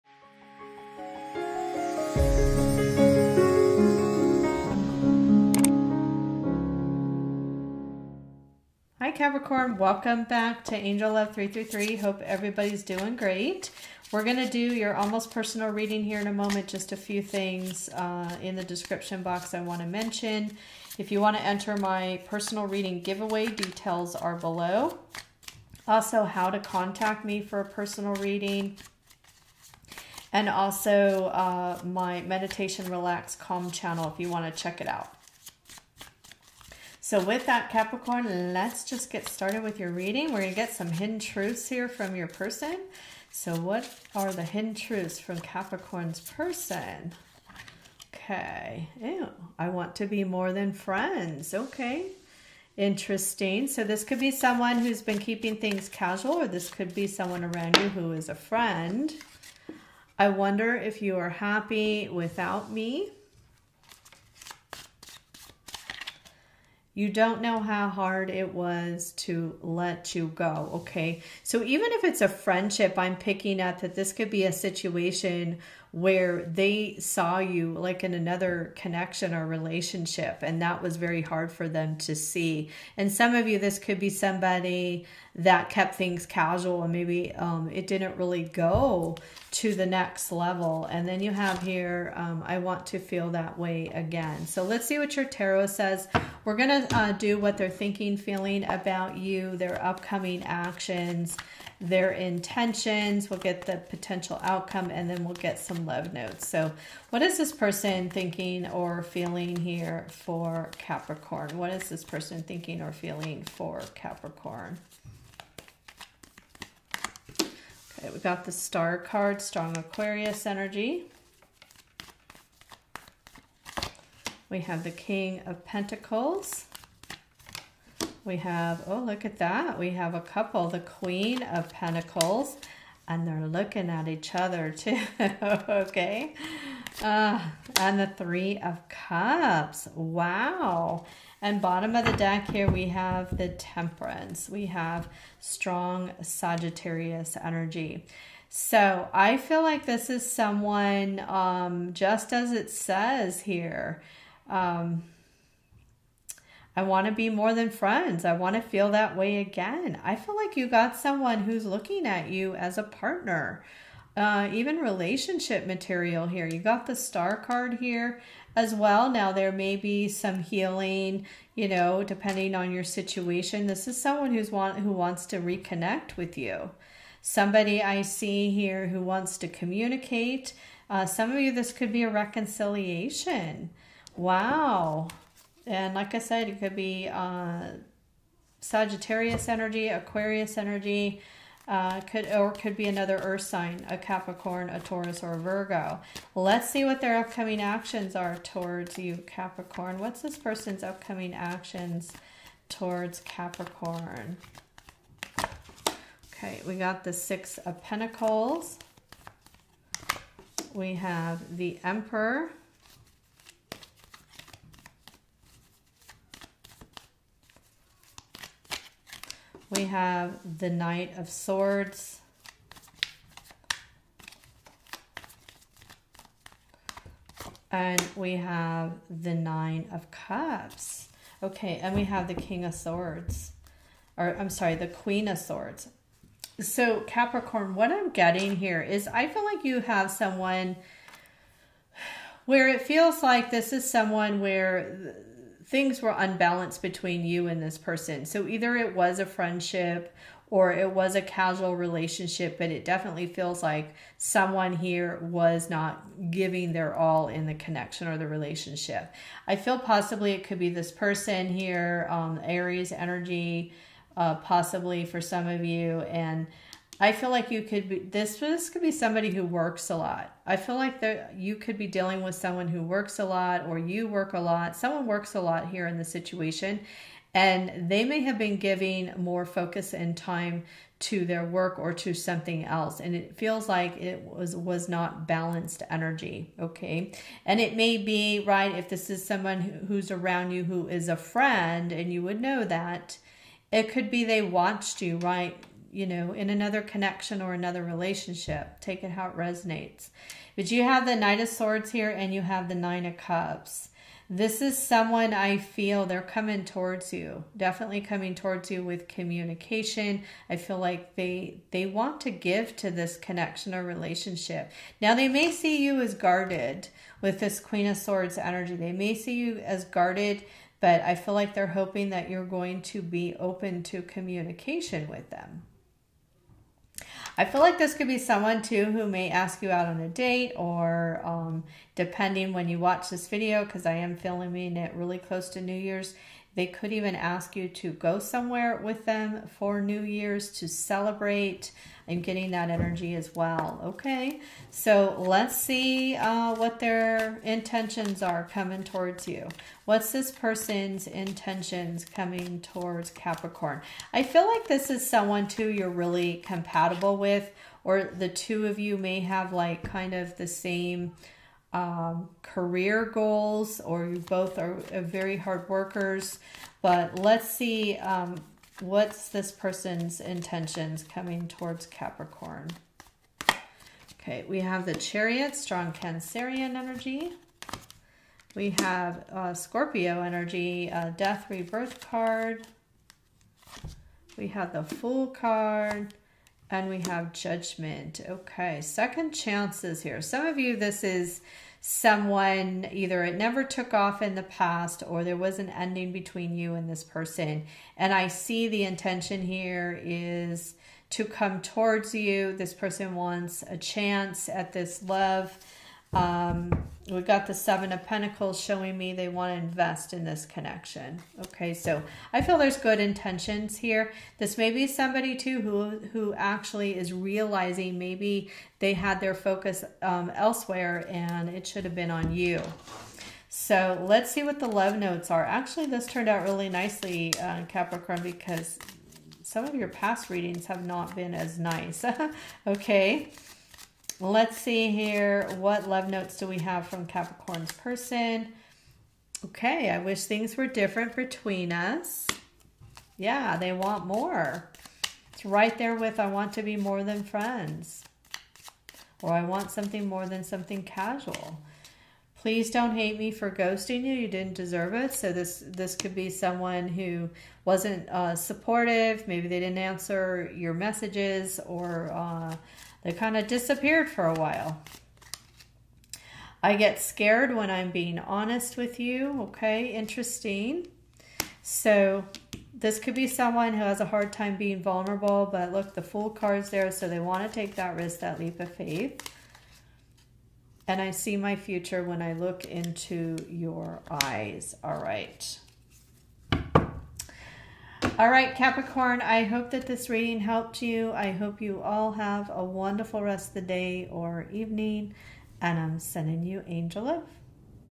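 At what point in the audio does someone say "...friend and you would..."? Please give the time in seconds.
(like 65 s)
291 s.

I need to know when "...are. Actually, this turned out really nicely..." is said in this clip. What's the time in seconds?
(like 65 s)
425 s.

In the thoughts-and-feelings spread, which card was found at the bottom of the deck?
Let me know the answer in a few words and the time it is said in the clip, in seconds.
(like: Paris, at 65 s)
Temperance, at 143 s.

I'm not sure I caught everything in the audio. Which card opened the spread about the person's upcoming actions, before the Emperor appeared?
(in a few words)
Six of Pentacles.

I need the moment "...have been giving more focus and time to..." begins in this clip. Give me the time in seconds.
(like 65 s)
278 s.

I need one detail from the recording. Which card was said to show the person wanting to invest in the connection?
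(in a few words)
Seven of Pentacles.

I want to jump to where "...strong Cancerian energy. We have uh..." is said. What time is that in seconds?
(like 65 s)
375 s.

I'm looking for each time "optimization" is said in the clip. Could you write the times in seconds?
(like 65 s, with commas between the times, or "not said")
not said.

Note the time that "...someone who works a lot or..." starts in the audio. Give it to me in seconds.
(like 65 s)
272 s.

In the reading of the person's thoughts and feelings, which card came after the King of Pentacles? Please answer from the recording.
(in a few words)
Queen of Pentacles.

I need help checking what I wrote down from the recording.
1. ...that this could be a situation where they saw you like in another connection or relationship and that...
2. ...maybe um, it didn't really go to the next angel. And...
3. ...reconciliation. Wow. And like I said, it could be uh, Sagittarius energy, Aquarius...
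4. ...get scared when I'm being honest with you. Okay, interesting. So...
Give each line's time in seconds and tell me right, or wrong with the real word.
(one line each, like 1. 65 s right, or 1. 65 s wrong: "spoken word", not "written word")
1. 73 s right
2. 86 s wrong: "level", not "angel"
3. 182 s right
4. 466 s right.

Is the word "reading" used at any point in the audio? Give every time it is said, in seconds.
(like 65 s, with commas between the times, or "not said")
15 s, 22 s, 28 s, 39 s, 430 s, 490 s.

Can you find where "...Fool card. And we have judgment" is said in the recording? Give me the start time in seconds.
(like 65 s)
384 s.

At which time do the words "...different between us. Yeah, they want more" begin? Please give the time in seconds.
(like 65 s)
440 s.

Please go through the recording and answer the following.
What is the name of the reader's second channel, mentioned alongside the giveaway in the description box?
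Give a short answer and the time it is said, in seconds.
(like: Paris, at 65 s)
Meditation Relax Calm, at 32 s.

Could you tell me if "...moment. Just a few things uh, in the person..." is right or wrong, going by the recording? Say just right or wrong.
wrong.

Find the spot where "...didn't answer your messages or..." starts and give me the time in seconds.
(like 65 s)
459 s.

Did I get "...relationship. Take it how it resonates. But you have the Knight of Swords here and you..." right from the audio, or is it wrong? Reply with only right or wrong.
right.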